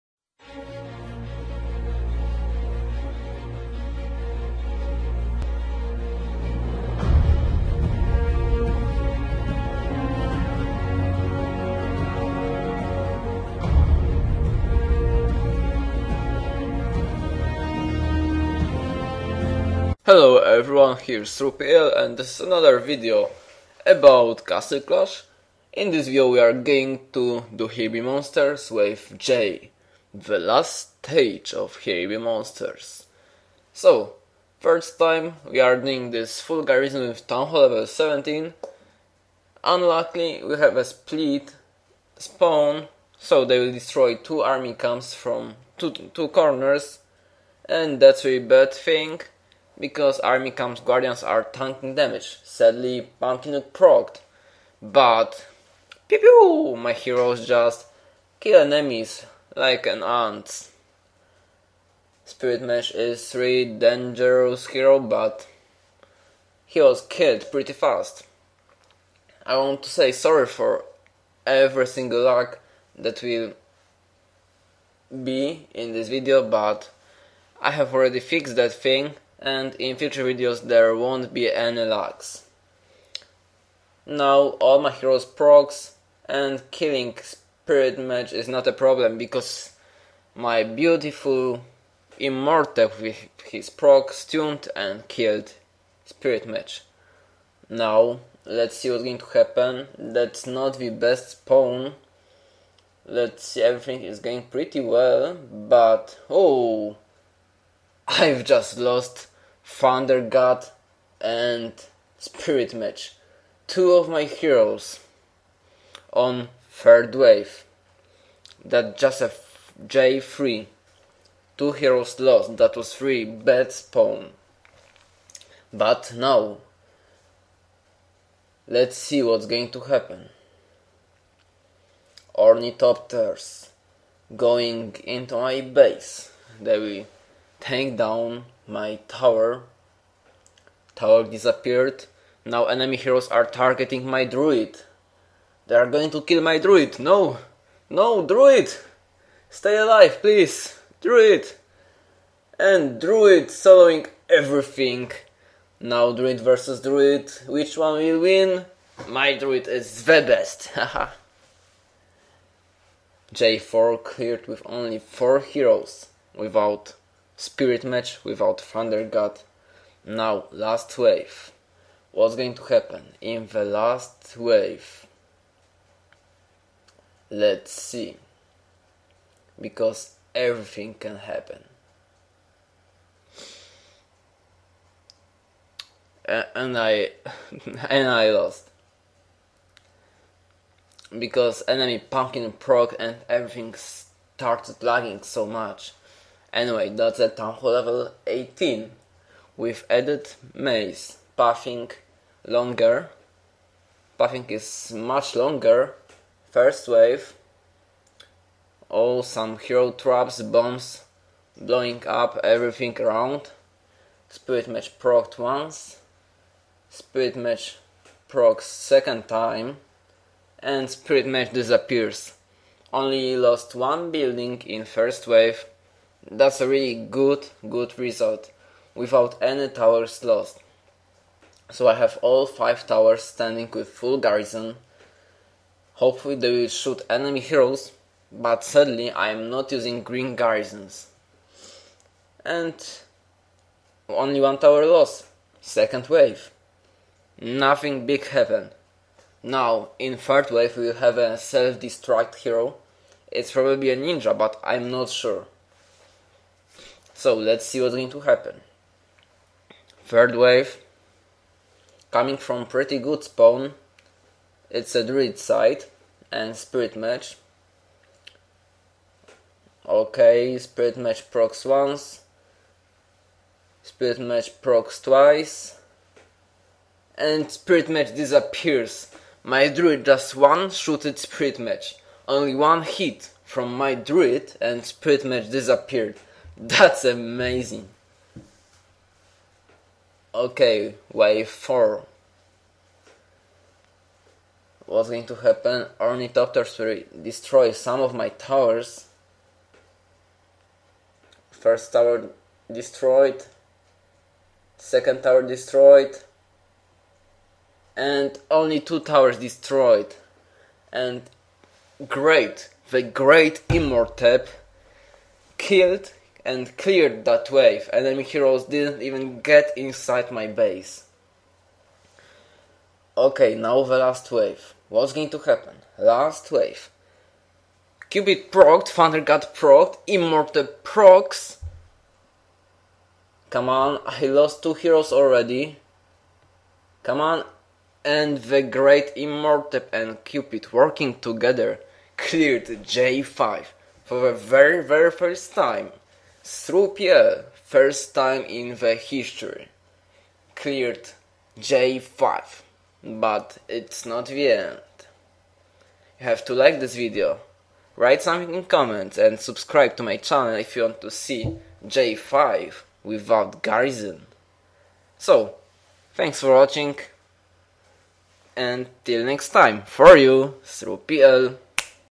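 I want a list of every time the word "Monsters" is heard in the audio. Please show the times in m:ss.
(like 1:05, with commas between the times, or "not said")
0:28, 0:32.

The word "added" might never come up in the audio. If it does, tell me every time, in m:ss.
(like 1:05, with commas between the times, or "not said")
3:19.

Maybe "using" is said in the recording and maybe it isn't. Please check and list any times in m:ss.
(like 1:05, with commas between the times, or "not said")
3:59.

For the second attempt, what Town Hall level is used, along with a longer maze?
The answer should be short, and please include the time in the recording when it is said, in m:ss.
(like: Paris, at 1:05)
18, at 3:17.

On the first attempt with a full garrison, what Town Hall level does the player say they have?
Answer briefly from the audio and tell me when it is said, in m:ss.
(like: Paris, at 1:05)
17, at 0:37.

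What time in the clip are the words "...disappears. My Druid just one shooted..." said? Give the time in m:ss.
4:38.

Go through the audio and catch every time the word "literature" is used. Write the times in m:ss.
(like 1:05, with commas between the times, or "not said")
not said.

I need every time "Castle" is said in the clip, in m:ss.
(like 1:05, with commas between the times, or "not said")
0:24.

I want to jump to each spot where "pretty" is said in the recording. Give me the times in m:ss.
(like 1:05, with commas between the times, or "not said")
1:07, 1:44, 4:22.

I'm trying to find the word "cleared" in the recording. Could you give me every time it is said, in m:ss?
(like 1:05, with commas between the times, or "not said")
2:44, 5:16, 5:42, 5:50.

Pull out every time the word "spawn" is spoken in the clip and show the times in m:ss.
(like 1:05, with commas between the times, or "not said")
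0:42, 1:41, 2:03, 4:23.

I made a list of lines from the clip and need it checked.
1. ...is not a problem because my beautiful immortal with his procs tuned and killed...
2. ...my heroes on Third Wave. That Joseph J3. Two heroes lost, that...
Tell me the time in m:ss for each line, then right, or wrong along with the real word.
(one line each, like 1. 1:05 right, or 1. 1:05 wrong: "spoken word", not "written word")
1. 1:28 right
2. 1:54 right.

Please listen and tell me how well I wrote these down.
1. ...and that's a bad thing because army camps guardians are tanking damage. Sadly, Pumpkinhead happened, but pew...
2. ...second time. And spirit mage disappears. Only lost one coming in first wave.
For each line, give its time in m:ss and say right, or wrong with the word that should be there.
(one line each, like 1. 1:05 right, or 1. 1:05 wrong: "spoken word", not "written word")
1. 0:47 wrong: "procced", not "happened"
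2. 3:38 wrong: "building", not "coming".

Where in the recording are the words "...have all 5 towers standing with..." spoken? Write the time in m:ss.
3:51.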